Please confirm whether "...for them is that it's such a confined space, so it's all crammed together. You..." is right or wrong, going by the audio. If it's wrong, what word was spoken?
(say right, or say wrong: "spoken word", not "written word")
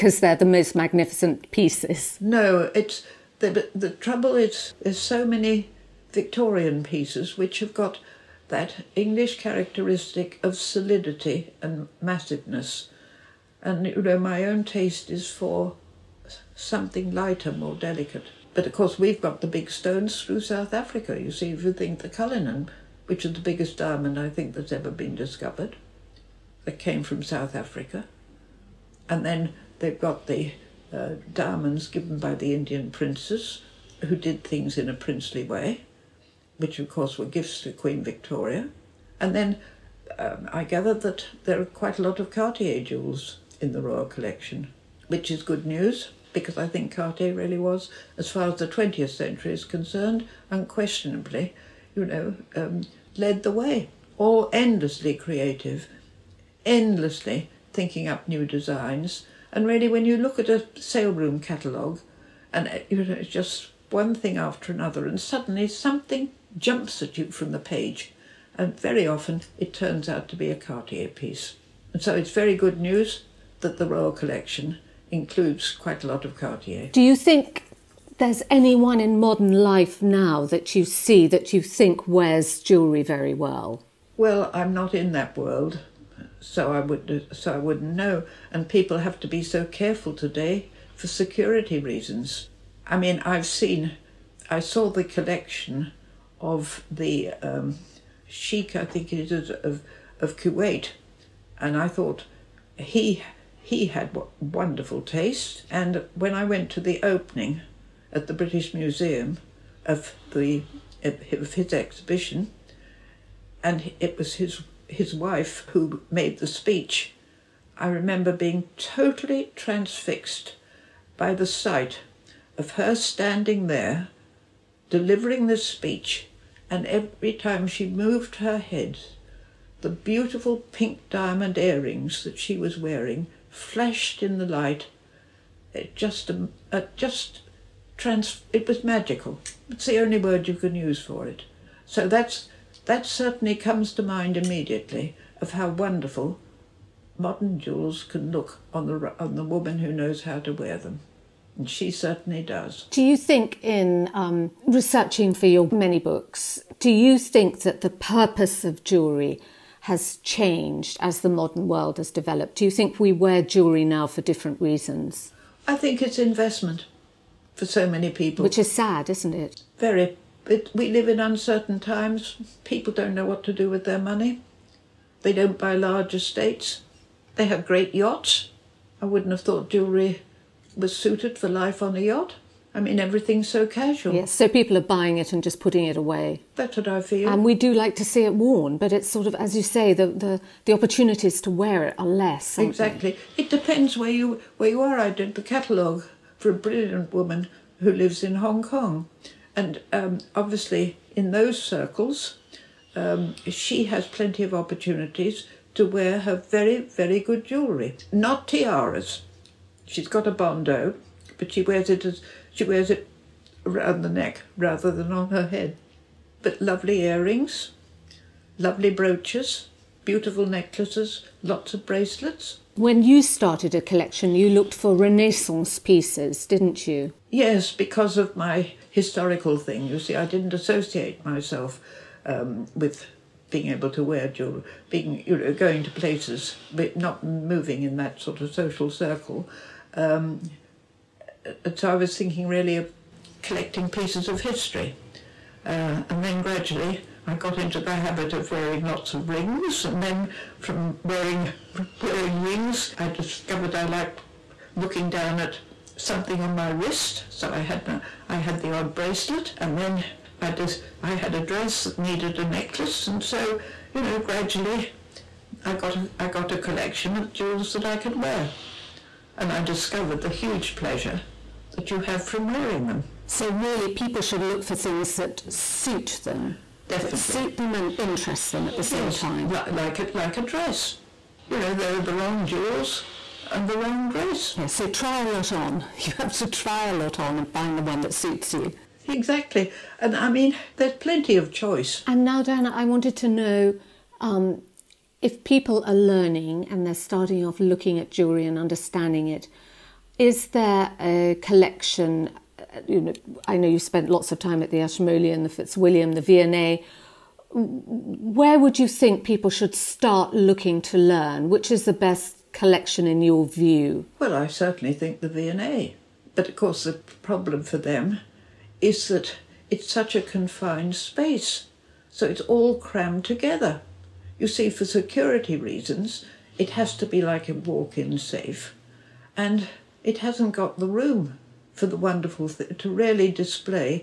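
right.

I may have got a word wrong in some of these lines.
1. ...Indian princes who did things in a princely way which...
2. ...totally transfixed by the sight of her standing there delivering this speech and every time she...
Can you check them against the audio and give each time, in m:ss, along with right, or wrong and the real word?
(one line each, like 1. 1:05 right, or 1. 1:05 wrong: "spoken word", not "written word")
1. 0:32 right
2. 1:58 right.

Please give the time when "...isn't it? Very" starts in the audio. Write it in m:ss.
2:49.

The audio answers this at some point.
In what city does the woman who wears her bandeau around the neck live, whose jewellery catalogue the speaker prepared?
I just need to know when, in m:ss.
3:18.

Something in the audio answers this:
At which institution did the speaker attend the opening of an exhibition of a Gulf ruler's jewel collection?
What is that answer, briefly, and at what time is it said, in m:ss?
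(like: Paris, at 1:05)
British Museum, at 1:48.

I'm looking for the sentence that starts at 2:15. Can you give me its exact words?
It just, a um, uh, just, trans, it was magical.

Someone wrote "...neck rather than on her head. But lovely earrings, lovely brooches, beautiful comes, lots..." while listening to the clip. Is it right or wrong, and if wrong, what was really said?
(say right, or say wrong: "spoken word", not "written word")
wrong: "necklaces", not "comes".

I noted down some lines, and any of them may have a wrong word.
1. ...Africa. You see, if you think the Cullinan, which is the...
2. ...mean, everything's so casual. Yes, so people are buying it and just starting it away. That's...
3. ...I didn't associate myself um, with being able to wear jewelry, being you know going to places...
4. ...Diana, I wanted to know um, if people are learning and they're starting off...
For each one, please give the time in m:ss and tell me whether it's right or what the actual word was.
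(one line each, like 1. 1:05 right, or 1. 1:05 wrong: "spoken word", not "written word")
1. 0:20 right
2. 3:02 wrong: "putting", not "starting"
3. 3:50 right
4. 4:52 right.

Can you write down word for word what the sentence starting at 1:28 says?
And people have to be so careful today for security reasons.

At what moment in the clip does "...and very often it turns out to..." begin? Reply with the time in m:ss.
1:08.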